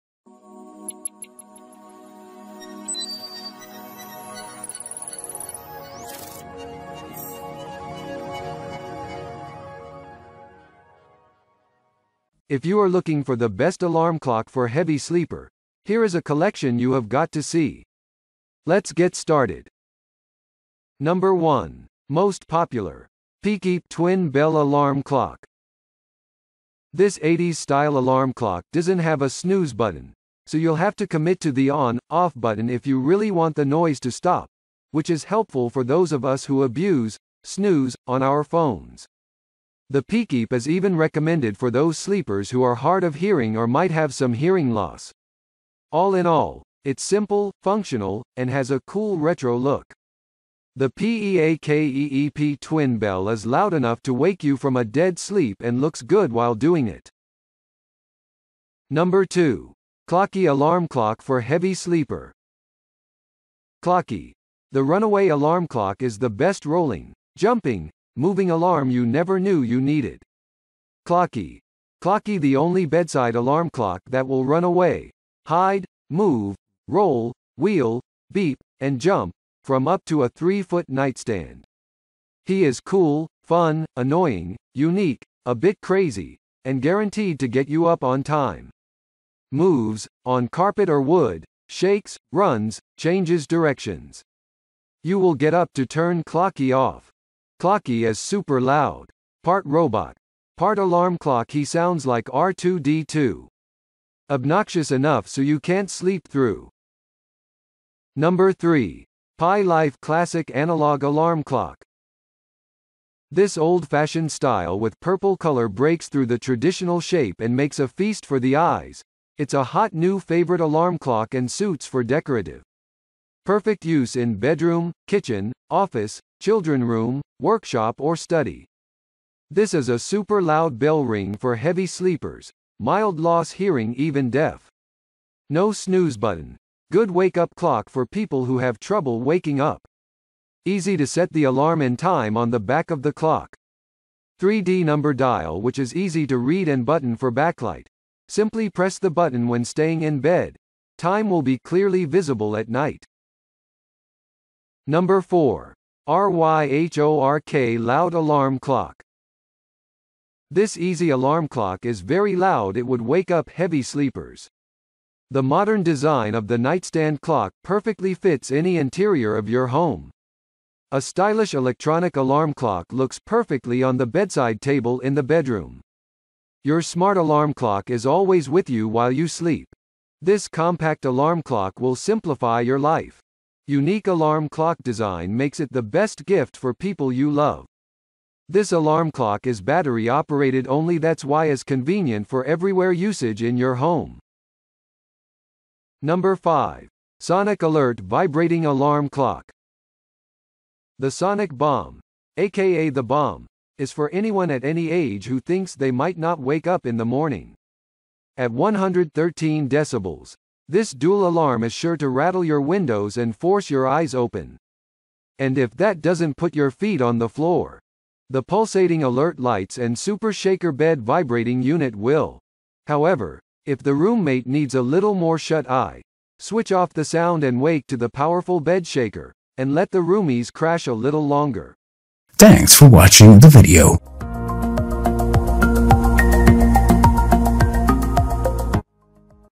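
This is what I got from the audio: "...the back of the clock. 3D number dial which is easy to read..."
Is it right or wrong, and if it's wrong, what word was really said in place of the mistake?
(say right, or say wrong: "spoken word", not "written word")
right.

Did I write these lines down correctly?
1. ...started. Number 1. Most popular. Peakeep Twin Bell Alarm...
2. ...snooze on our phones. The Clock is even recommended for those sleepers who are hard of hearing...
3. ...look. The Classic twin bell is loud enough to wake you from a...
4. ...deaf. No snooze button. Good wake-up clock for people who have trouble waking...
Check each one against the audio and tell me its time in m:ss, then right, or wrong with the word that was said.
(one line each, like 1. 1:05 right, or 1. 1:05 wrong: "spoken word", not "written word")
1. 0:19 right
2. 0:37 wrong: "Peakeep", not "Clock"
3. 0:49 wrong: "PEAKEEP", not "Classic"
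4. 2:14 right.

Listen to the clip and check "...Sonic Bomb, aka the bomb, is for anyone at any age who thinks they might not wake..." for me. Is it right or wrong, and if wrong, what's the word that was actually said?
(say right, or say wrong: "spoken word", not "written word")
right.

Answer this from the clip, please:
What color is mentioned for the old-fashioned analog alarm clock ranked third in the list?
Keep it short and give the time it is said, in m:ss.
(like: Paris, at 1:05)
Purple, at 1:54.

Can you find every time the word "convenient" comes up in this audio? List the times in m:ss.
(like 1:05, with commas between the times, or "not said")
3:11.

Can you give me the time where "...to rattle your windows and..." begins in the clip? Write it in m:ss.
3:31.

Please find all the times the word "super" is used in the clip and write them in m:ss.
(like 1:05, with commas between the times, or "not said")
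1:38, 2:09, 3:39.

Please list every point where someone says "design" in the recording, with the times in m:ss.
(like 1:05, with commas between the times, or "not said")
2:45, 3:04.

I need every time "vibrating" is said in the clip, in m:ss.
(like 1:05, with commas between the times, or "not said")
3:18, 3:41.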